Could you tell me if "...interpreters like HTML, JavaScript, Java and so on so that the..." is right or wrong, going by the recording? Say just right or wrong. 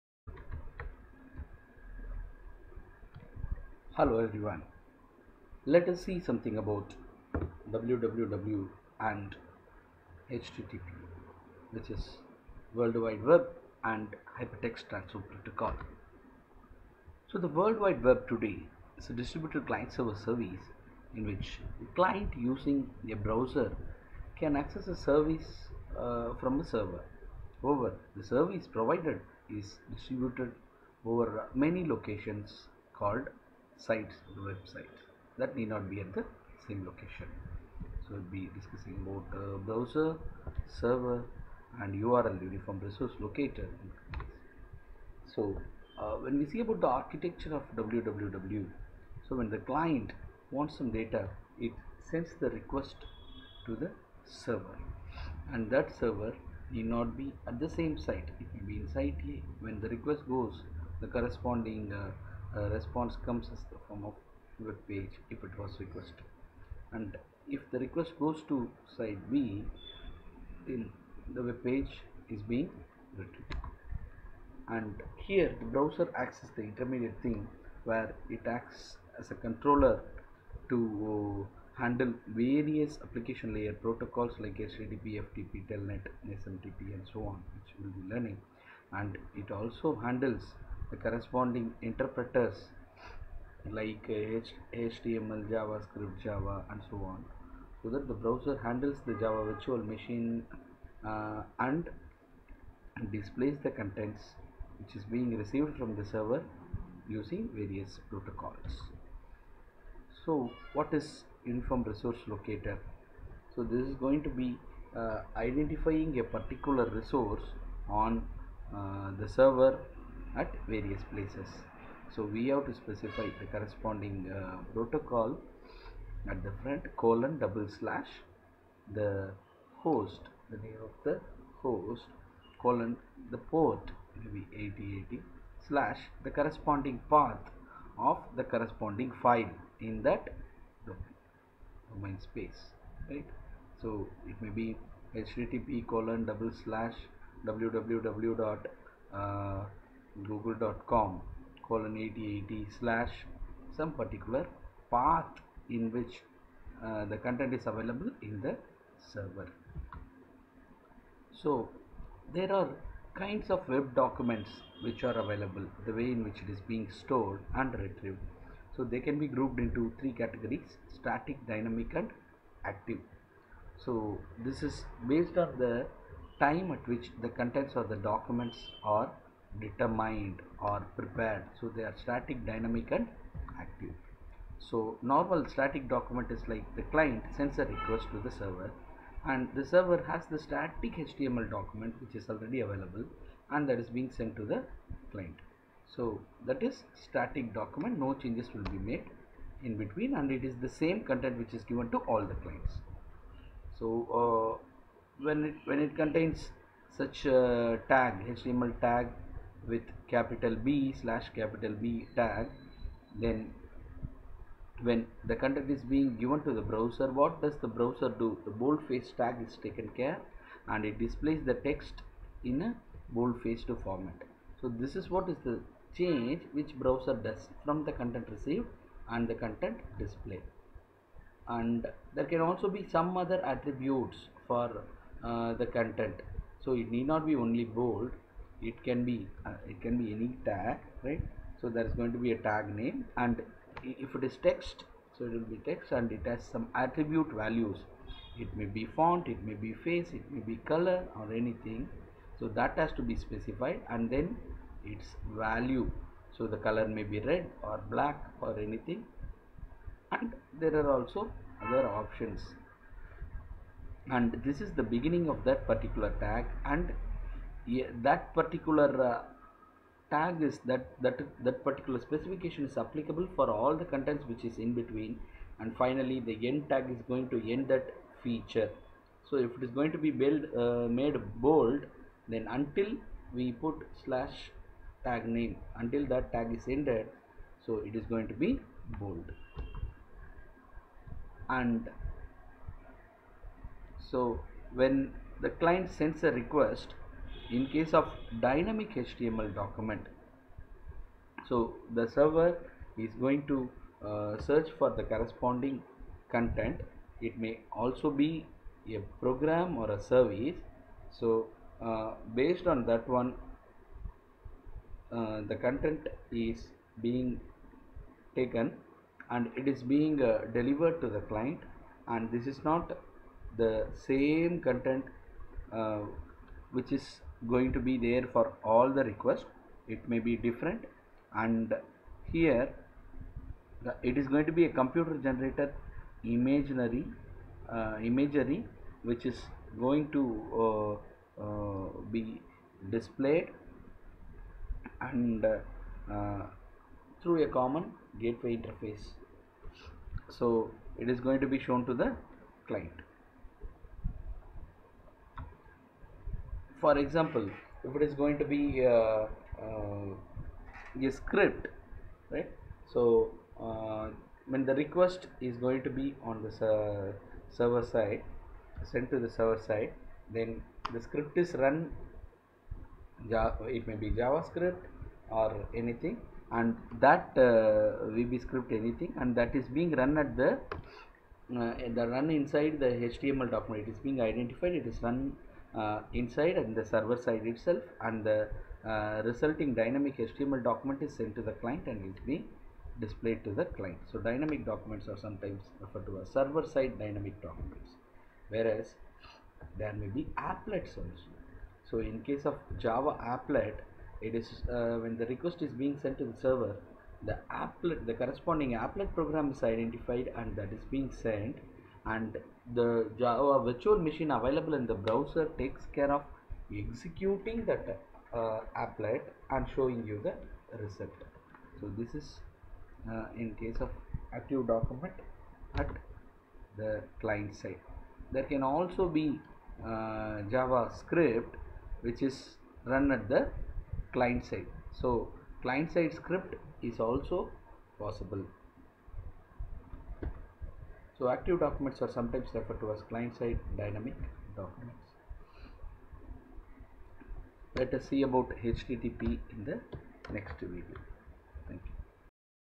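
right.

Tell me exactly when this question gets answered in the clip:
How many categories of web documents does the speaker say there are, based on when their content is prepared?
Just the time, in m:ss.
2:49.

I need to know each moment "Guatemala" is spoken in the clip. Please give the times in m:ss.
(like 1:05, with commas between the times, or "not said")
not said.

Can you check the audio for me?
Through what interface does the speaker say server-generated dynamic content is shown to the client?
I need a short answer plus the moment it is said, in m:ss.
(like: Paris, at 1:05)
common gateway interface, at 5:47.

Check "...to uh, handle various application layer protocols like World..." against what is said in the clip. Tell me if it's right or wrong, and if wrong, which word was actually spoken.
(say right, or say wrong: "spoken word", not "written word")
wrong: "HTTP", not "World".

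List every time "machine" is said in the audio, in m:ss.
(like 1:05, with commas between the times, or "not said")
1:39, 6:53.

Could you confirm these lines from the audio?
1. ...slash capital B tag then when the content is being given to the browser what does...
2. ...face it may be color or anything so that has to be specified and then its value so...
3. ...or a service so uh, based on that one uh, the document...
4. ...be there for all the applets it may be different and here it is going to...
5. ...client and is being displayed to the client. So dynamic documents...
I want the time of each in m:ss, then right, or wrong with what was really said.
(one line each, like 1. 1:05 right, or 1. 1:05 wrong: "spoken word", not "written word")
1. 3:31 right
2. 4:09 right
3. 5:09 wrong: "content", not "document"
4. 5:27 wrong: "requests", not "applets"
5. 6:31 right.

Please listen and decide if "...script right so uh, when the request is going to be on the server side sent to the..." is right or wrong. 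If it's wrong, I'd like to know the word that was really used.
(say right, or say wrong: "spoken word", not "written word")
right.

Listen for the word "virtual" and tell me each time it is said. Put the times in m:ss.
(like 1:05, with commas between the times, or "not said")
1:39, 6:53.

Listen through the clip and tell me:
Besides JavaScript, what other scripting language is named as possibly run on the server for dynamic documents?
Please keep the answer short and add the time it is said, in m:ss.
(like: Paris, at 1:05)
VB script, at 6:18.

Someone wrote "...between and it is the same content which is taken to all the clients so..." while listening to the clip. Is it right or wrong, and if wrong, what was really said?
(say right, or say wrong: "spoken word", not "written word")
wrong: "given", not "taken".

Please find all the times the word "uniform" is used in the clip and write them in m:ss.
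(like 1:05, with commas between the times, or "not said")
0:42, 1:51.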